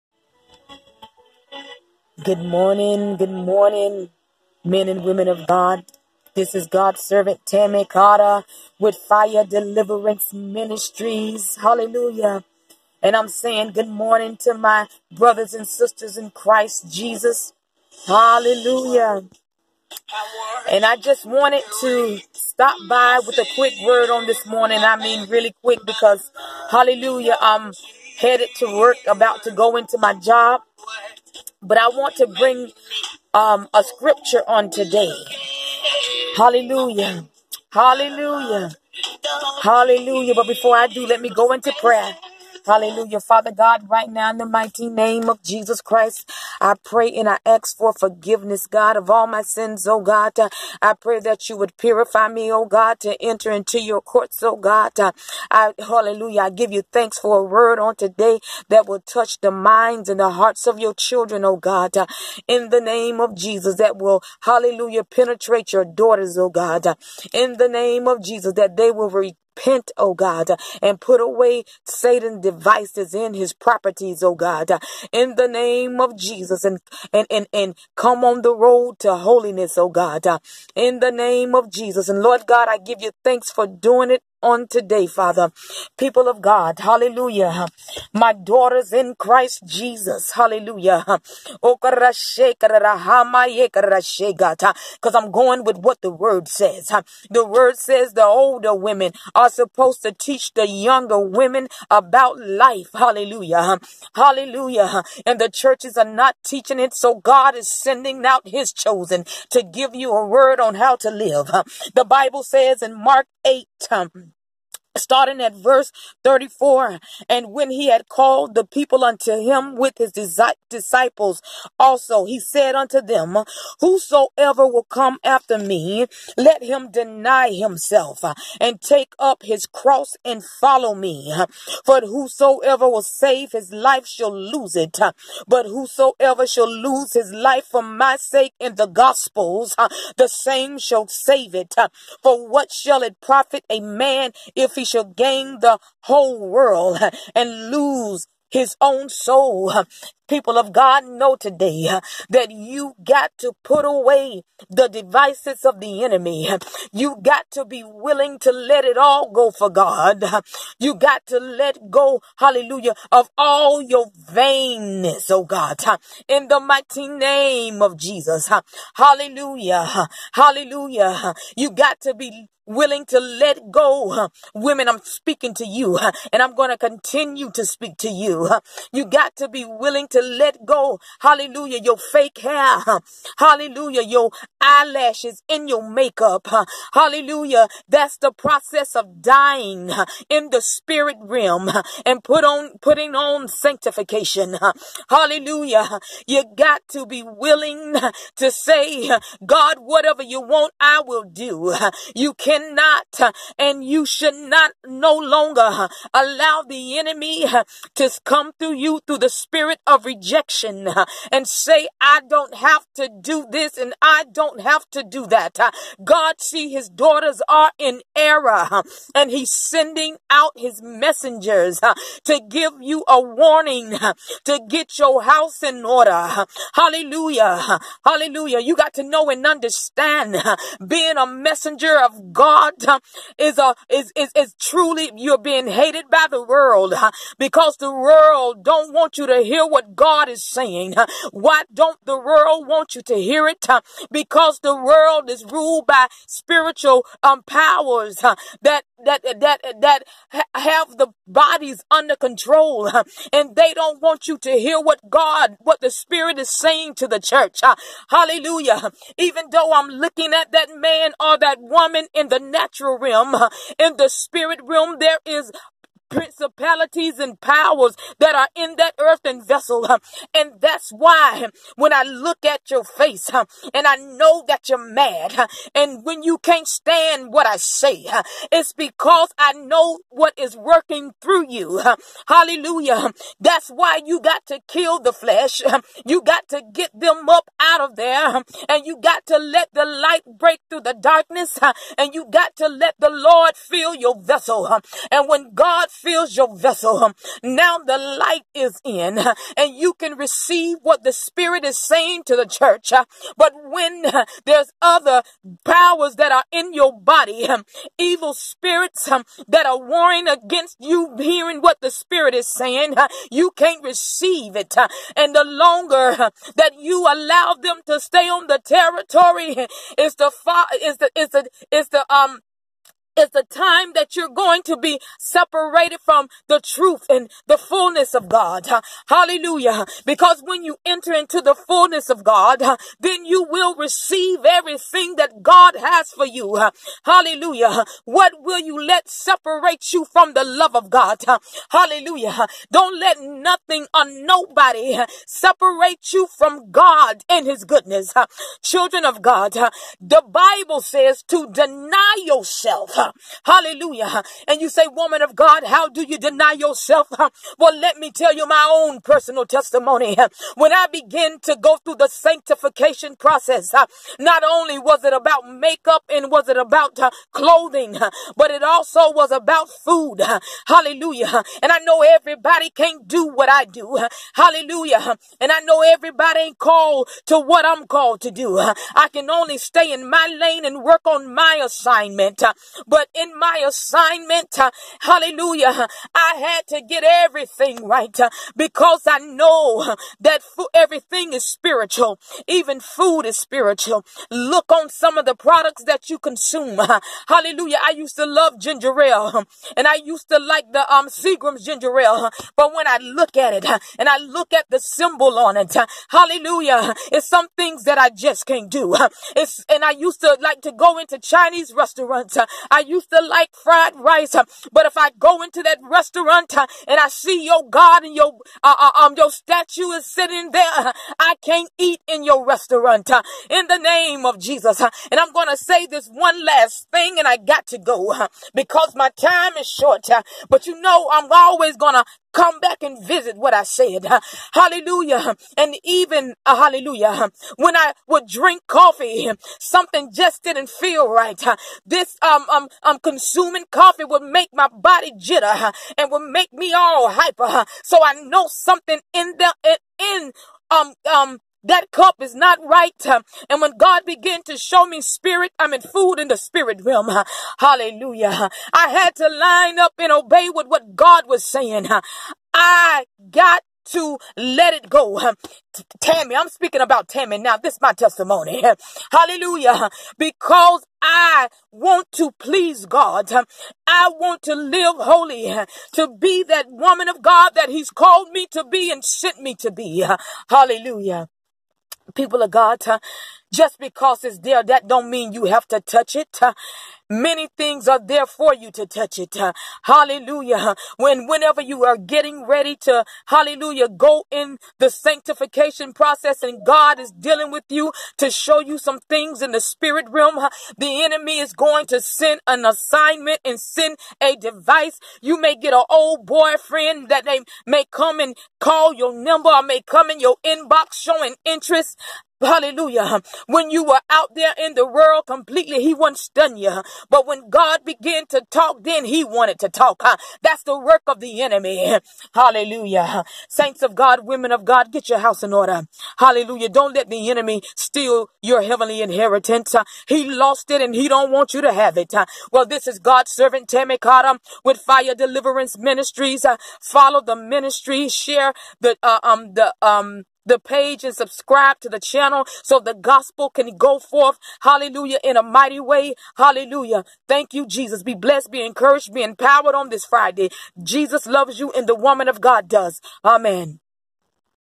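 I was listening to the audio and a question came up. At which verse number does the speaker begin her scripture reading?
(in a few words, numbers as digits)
34.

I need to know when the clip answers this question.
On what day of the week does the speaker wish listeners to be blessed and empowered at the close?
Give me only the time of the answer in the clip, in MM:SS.
09:10.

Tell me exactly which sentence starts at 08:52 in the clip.
Well, this is God's servant Tammy Cottom with Fire Deliverance Ministries.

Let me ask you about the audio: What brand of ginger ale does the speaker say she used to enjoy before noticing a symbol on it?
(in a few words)
Seagram's.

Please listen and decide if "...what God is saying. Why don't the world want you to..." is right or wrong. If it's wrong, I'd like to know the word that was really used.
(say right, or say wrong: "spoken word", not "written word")
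right.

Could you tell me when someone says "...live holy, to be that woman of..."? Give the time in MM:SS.
07:54.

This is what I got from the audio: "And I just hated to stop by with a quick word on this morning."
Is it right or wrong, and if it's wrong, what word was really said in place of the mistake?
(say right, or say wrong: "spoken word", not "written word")
wrong: "wanted", not "hated".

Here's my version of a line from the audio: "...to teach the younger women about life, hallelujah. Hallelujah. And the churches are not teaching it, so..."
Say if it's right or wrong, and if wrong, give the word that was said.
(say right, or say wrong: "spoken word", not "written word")
right.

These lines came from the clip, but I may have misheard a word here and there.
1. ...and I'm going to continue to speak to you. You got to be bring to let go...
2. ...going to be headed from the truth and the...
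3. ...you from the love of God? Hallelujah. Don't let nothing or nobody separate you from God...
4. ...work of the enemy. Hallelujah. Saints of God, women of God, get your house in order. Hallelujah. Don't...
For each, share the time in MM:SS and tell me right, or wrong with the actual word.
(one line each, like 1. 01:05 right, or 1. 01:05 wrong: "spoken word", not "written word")
1. 02:56 wrong: "willing", not "bring"
2. 05:24 wrong: "separated", not "headed"
3. 05:39 right
4. 08:40 right.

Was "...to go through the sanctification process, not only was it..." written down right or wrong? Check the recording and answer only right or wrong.
right.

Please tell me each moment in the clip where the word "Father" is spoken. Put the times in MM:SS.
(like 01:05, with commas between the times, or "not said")
00:43, 01:25.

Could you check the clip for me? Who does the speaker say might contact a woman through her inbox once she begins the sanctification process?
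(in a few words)
an old boyfriend.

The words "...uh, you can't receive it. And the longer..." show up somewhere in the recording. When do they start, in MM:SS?
05:12.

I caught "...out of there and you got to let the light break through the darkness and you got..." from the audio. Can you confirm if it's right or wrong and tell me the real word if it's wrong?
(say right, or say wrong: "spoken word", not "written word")
right.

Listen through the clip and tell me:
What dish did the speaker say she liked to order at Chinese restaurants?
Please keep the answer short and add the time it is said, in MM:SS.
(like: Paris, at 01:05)
fried rice, at 06:53.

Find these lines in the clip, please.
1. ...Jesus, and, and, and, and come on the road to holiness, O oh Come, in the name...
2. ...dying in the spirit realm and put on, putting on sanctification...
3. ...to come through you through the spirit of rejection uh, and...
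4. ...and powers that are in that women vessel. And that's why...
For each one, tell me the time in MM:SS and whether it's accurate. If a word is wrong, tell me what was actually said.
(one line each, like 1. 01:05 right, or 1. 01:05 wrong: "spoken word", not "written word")
1. 01:16 wrong: "God", not "Come"
2. 03:09 right
3. 03:27 right
4. 04:27 wrong: "earthen", not "women".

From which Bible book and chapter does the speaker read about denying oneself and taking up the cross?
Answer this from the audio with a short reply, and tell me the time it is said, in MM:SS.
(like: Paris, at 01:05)
Mark 8, at 01:53.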